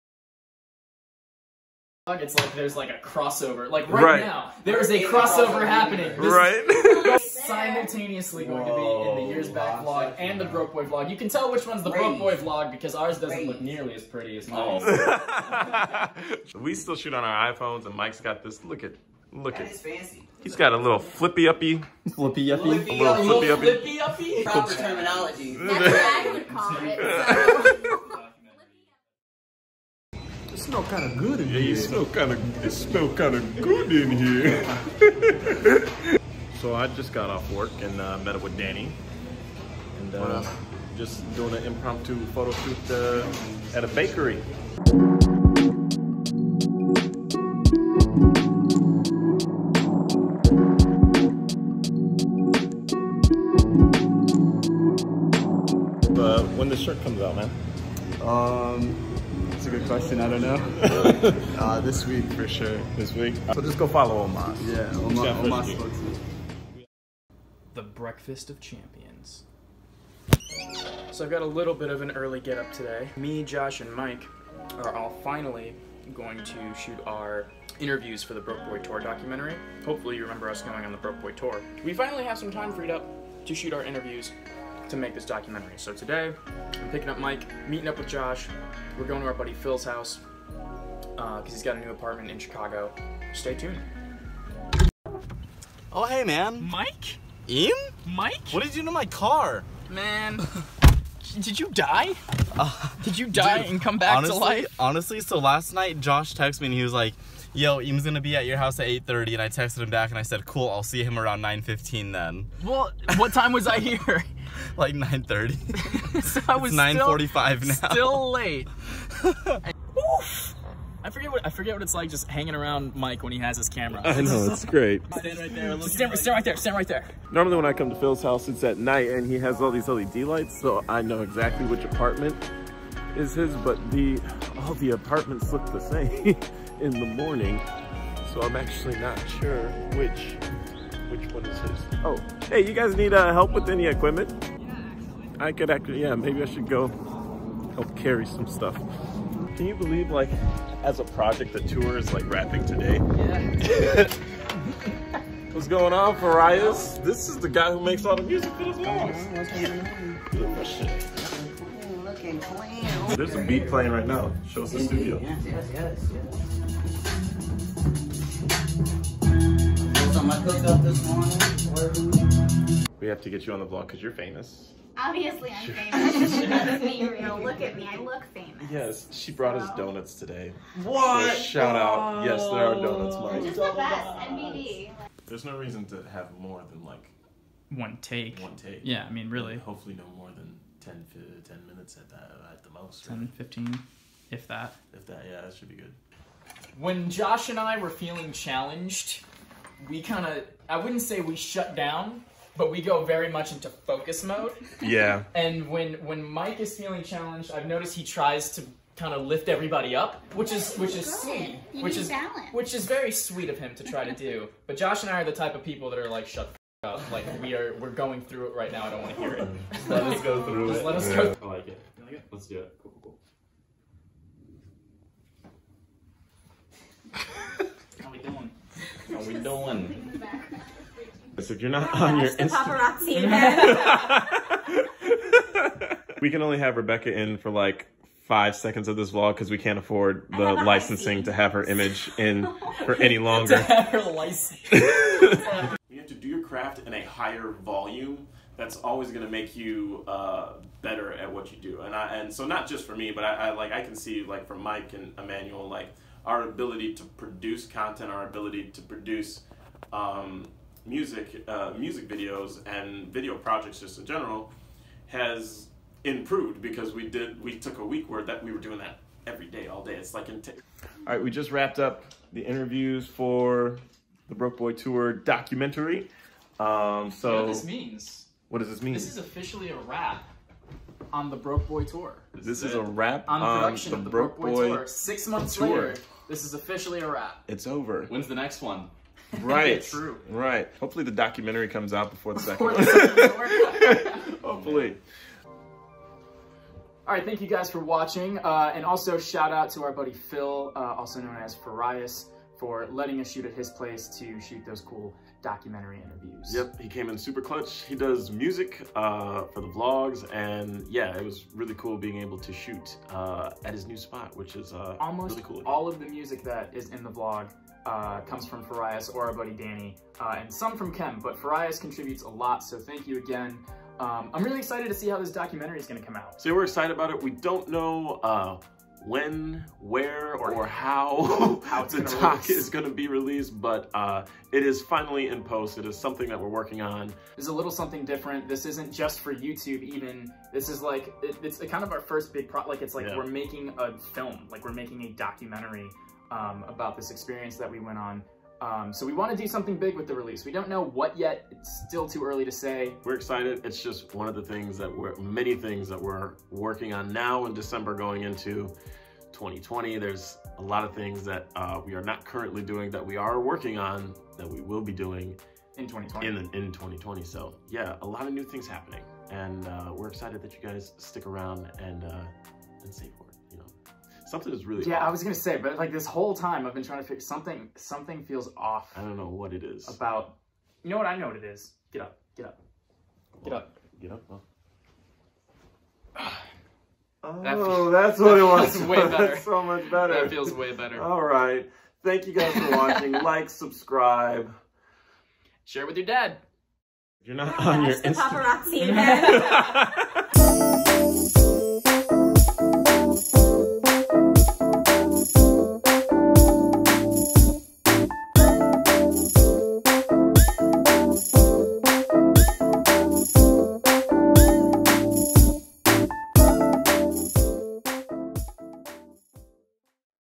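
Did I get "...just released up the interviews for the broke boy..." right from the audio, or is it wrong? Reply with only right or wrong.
wrong.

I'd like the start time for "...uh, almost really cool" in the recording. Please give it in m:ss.
5:14.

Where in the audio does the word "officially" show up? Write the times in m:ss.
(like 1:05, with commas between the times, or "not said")
4:39, 4:46.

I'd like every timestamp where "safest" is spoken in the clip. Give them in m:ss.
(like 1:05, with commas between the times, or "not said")
not said.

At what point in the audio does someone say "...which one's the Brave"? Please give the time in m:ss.
0:11.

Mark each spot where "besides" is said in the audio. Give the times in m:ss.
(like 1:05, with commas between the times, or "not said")
not said.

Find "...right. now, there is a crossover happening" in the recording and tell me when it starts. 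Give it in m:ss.
0:04.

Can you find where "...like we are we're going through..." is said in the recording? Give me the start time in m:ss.
3:37.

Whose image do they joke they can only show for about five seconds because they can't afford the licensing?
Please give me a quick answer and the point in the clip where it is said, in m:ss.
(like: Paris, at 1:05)
Rebecca, at 3:56.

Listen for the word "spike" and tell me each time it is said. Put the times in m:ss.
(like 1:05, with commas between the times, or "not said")
not said.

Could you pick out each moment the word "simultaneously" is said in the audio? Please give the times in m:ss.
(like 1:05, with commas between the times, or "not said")
0:07.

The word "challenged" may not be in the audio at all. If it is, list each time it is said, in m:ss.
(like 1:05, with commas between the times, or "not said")
3:18, 3:27.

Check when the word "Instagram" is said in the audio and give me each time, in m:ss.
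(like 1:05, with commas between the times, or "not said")
3:53, 6:37.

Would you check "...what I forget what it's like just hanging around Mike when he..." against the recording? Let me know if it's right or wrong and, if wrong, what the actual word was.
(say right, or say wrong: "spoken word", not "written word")
right.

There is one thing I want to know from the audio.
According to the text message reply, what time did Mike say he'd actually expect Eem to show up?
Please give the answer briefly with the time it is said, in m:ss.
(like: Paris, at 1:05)
9:15, at 1:51.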